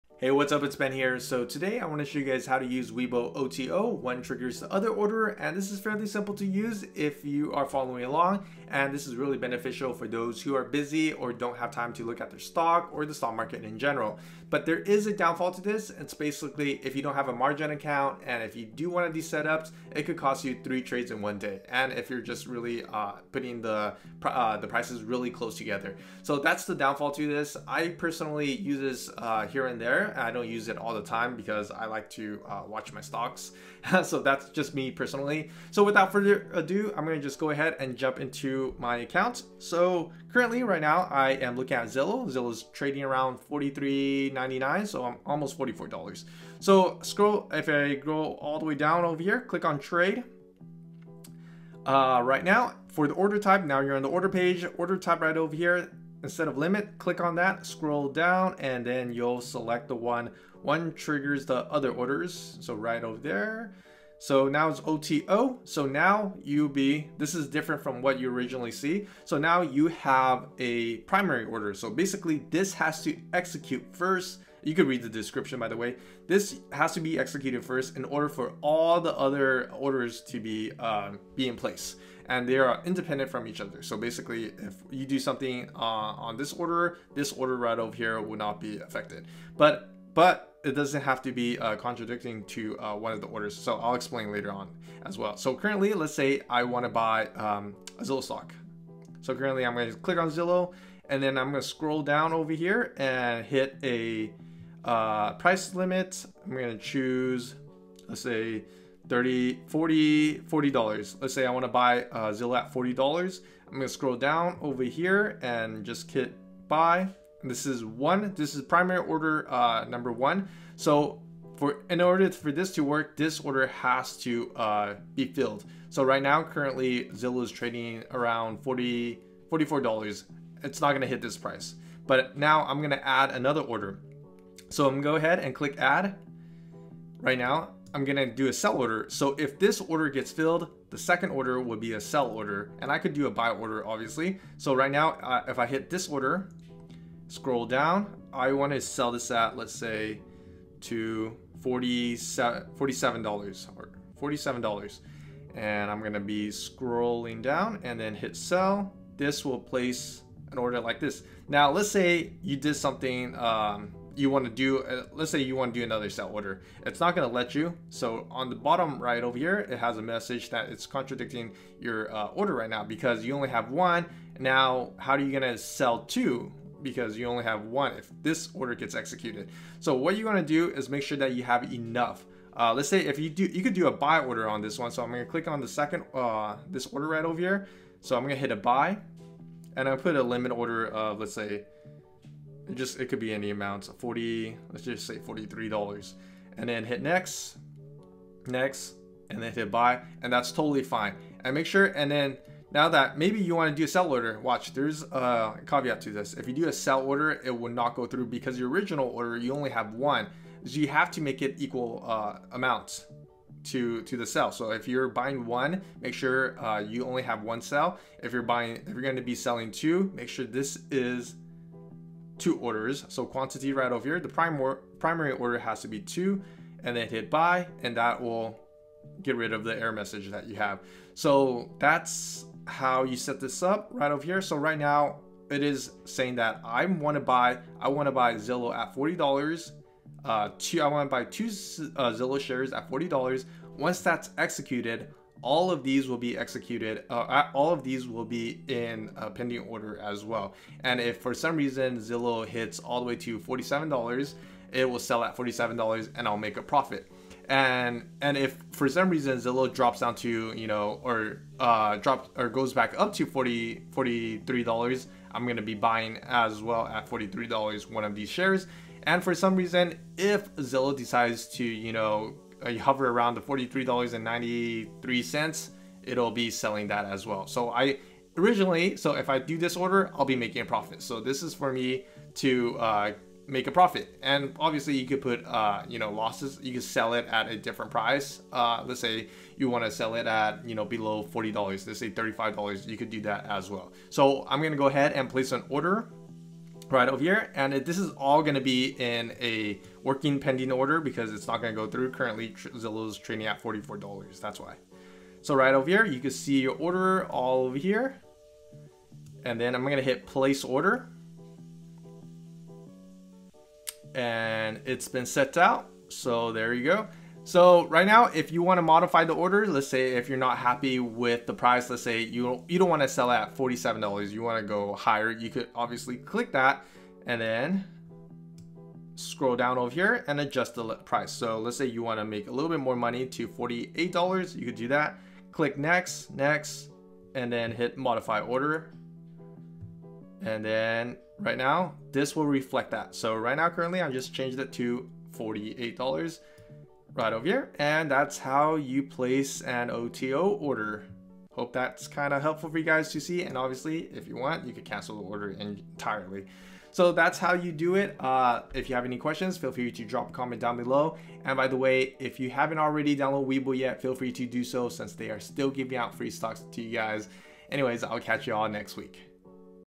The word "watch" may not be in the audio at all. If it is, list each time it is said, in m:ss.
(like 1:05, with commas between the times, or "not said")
0:32, 3:24.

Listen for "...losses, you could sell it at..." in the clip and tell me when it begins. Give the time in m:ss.
4:46.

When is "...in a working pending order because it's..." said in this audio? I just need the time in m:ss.
4:59.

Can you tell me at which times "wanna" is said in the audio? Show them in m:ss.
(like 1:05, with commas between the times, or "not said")
1:51, 2:28.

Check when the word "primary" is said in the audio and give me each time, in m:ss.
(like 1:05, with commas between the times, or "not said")
1:11, 1:58, 3:44.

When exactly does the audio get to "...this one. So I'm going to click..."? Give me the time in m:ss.
3:04.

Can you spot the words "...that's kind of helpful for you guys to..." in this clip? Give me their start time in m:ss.
5:51.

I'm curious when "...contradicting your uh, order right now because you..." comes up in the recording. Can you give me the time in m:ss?
2:50.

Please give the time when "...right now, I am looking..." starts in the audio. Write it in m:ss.
0:40.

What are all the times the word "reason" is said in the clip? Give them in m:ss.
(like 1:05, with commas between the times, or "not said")
4:11, 4:19, 4:29.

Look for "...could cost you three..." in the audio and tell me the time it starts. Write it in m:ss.
0:20.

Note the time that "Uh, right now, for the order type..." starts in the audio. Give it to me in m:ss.
0:51.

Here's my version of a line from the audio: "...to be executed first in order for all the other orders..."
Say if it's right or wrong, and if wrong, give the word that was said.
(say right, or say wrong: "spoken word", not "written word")
right.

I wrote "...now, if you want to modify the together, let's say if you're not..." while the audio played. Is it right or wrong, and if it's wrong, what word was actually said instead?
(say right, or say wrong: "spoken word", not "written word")
wrong: "order", not "together".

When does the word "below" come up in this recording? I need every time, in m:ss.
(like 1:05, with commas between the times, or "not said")
4:50, 6:00.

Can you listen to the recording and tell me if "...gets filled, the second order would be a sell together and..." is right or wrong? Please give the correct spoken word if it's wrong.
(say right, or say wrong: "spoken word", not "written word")
wrong: "order", not "together".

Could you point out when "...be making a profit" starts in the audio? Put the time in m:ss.
4:40.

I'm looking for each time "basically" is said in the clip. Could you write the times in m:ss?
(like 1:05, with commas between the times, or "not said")
0:16, 1:11, 1:23.